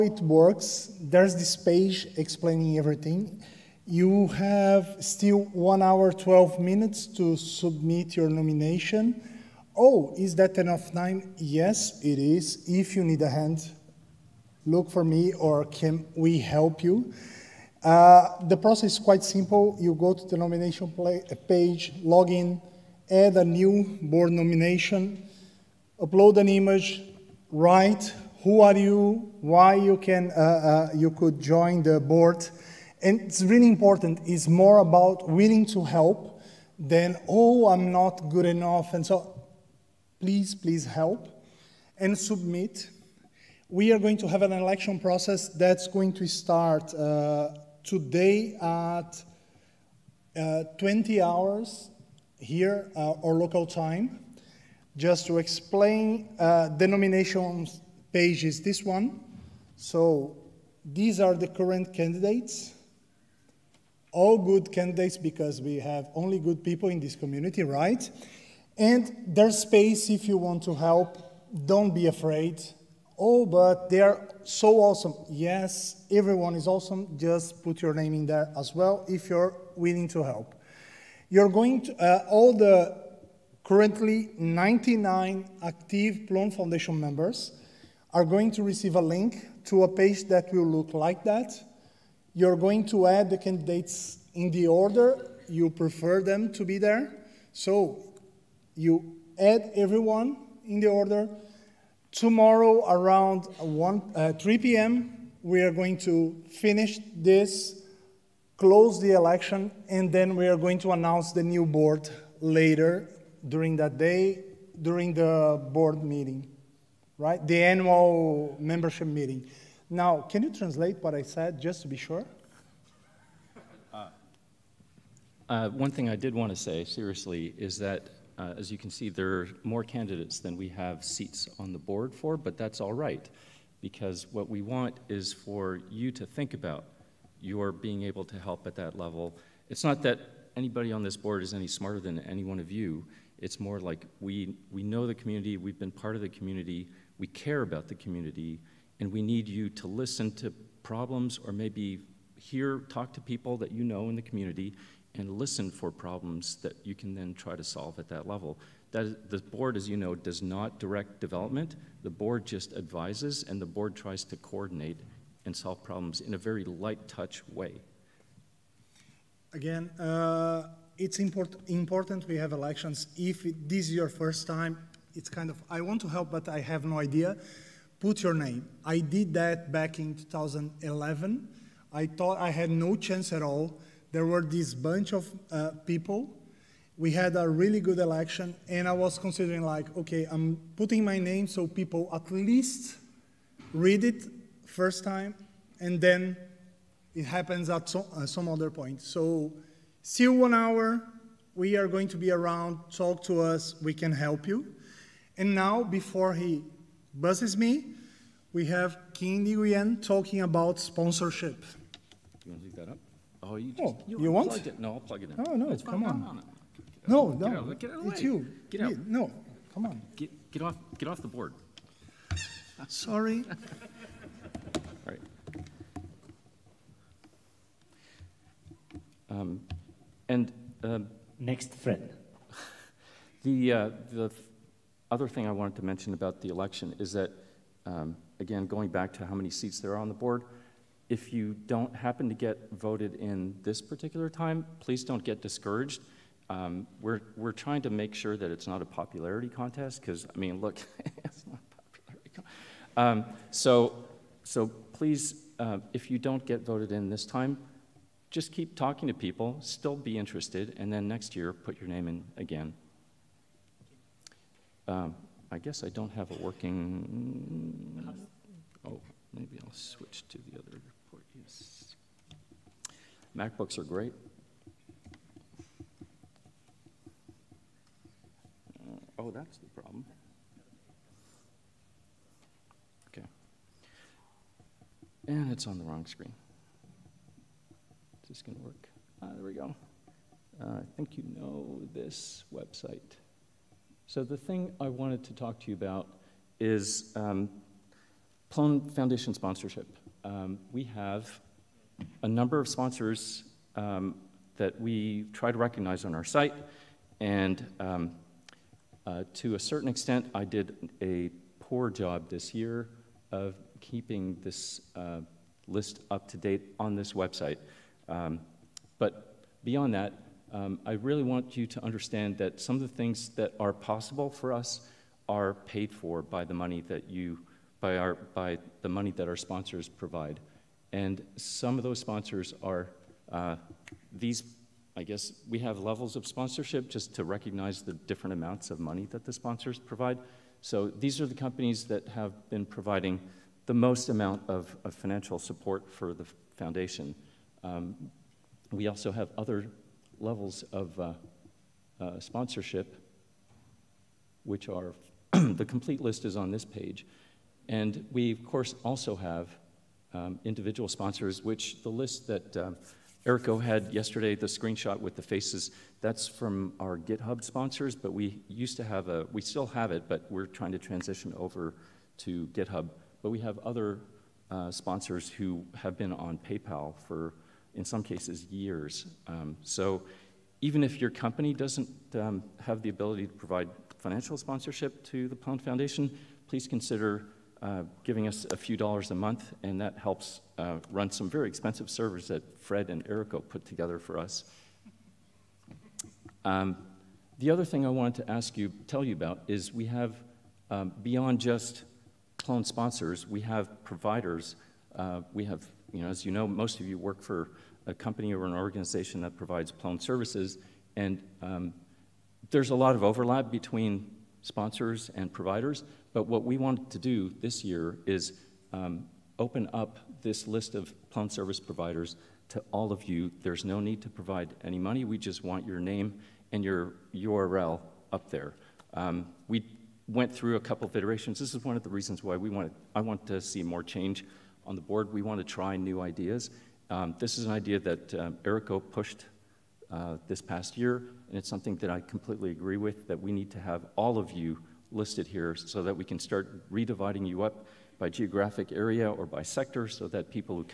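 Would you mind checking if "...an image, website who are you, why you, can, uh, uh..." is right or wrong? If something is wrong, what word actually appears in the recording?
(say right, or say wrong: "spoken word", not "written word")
wrong: "write", not "website".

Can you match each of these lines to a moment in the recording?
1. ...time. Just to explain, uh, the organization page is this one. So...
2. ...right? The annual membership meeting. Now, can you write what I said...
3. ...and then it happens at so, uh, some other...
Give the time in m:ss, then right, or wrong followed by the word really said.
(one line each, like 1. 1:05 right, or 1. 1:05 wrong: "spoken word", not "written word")
1. 0:53 wrong: "nomination", not "organization"
2. 1:57 wrong: "translate", not "write"
3. 3:15 right.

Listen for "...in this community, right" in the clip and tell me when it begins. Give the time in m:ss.
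1:06.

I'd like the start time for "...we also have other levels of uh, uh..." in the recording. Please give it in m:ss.
5:48.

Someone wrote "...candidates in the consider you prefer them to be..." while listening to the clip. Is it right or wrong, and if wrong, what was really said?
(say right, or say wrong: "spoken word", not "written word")
wrong: "order", not "consider".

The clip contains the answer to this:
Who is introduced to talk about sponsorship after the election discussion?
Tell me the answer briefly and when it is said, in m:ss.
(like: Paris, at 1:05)
Kim Nguyen, at 3:29.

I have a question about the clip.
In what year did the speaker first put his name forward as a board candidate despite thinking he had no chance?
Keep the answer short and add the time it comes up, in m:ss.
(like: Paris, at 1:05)
2011, at 3:00.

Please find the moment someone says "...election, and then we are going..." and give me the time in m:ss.
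1:49.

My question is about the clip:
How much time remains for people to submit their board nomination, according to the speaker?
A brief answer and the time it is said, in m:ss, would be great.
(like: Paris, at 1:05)
1 hour 12 minutes, at 0:05.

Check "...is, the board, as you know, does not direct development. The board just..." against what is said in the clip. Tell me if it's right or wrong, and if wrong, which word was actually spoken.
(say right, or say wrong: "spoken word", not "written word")
right.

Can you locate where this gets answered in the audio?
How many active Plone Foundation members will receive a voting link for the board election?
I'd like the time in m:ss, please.
1:24.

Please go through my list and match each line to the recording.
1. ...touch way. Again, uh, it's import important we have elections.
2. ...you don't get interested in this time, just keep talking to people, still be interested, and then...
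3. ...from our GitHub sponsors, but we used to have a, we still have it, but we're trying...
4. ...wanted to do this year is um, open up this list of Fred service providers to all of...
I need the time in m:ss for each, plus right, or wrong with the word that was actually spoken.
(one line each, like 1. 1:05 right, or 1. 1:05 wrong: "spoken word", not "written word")
1. 2:47 right
2. 4:16 wrong: "voted", not "interested"
3. 6:06 right
4. 6:56 wrong: "Plone", not "Fred".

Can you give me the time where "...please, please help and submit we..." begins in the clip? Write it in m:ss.
0:40.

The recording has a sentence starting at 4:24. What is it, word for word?
Um, I guess I don't have a working, oh, maybe I'll switch to the other.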